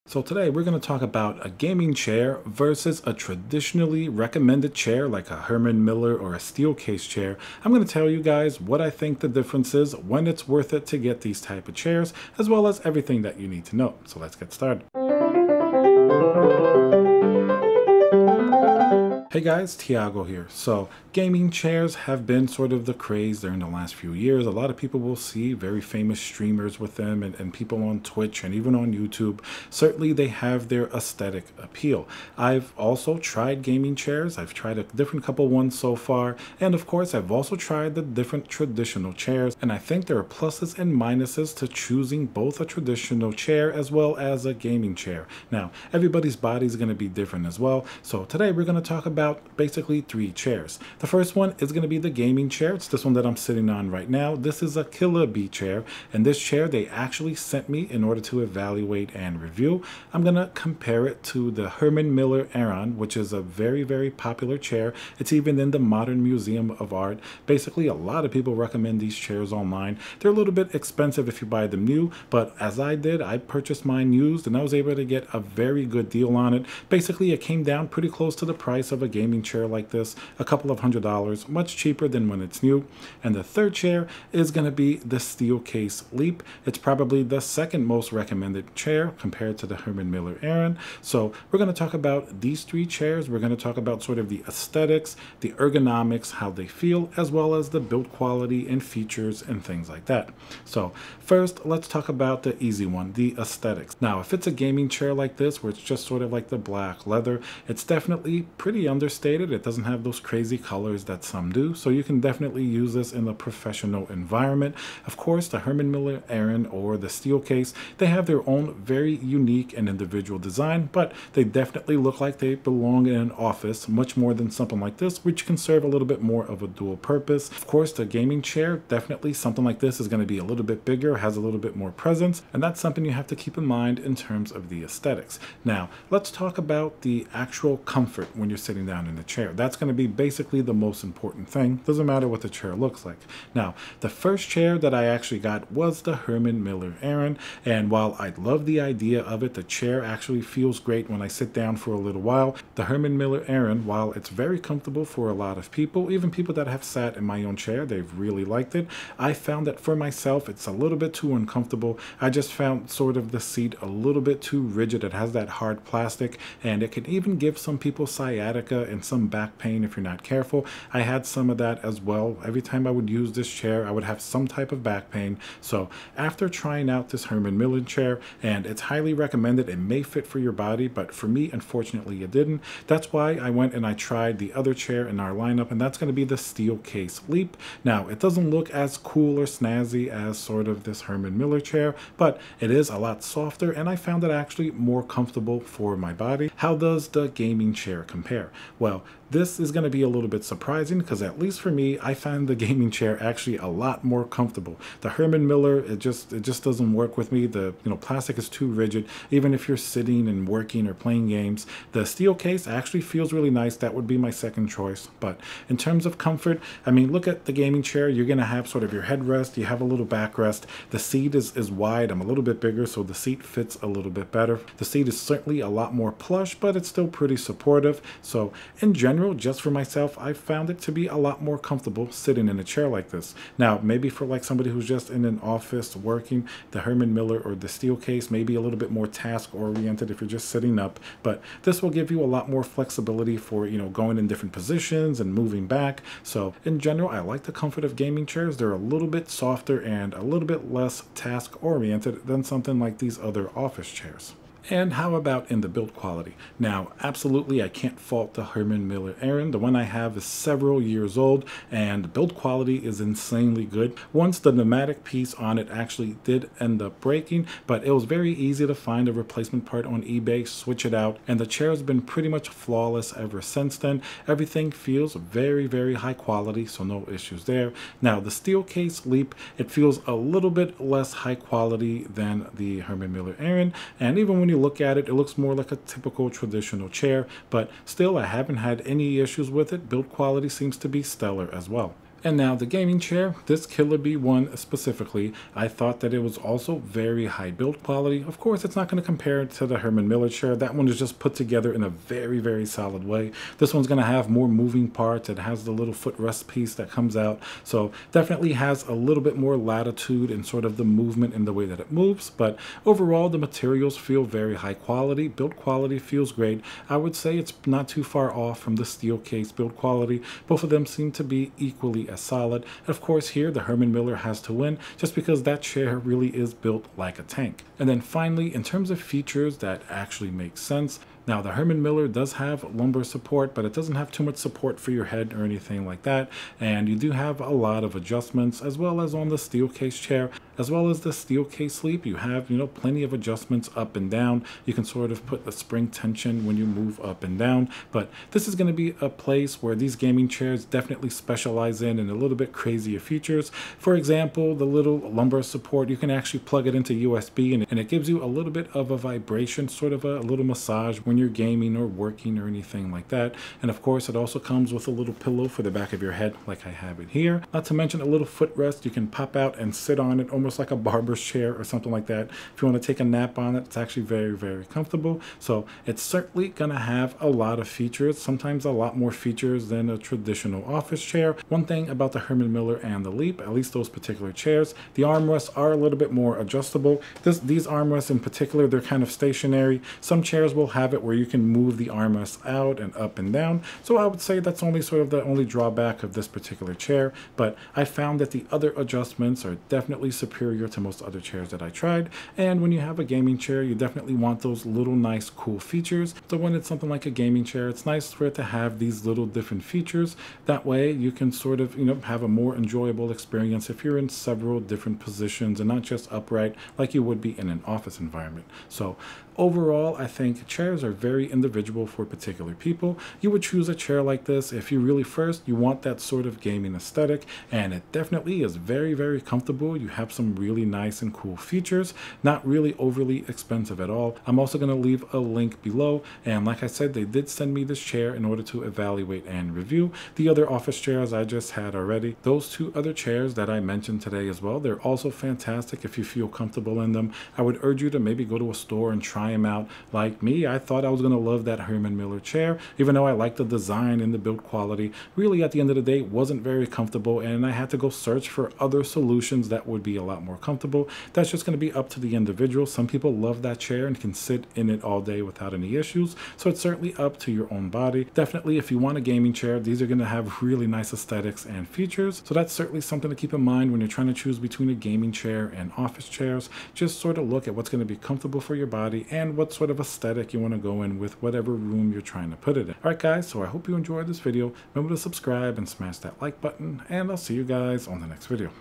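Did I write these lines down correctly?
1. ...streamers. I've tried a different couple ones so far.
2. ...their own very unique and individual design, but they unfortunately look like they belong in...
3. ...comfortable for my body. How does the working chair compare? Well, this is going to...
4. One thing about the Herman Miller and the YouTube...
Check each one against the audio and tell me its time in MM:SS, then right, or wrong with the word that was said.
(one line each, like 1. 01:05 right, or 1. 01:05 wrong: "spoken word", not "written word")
1. 00:33 wrong: "chairs", not "streamers"
2. 01:58 wrong: "definitely", not "unfortunately"
3. 03:15 wrong: "gaming", not "working"
4. 06:21 wrong: "Leap", not "YouTube".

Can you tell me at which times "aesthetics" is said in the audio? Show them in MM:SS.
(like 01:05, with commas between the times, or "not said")
00:30, 01:34, 01:43, 02:14, 07:06, 07:50, 07:59.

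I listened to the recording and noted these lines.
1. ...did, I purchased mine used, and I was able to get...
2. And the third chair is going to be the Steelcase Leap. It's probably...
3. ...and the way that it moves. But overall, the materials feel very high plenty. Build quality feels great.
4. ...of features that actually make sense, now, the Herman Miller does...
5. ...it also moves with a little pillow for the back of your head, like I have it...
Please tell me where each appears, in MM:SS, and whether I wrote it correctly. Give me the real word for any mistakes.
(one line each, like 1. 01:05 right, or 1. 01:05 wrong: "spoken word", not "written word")
1. 01:12 right
2. 01:23 right
3. 05:11 wrong: "quality", not "plenty"
4. 05:28 right
5. 06:04 wrong: "comes", not "moves".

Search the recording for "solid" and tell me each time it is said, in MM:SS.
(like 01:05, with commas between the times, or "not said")
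05:02, 05:22.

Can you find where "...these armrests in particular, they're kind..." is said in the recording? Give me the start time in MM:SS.
06:27.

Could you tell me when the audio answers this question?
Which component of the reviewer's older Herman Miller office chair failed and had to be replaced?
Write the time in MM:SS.
04:24.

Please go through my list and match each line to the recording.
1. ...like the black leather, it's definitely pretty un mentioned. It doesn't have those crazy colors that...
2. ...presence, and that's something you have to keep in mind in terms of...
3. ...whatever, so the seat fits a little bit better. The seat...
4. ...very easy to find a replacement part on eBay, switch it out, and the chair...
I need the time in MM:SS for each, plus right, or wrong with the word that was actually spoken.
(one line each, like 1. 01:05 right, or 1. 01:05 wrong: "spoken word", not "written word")
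1. 01:46 wrong: "understated", not "mentioned"
2. 02:11 right
3. 03:42 wrong: "bigger", not "whatever"
4. 04:28 right.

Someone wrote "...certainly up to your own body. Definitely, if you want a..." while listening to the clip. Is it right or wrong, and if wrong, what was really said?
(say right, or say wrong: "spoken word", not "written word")
right.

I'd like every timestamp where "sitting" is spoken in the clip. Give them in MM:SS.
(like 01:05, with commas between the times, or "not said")
00:53, 02:18, 03:29, 03:52, 04:00.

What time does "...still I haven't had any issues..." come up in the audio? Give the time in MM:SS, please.
04:47.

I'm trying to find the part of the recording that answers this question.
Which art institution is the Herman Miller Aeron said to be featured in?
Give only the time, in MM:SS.
01:05.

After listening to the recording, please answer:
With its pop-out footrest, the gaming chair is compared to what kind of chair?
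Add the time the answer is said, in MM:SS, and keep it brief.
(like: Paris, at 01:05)
barber's chair, at 06:10.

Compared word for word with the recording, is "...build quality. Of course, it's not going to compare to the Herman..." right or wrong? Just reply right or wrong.
right.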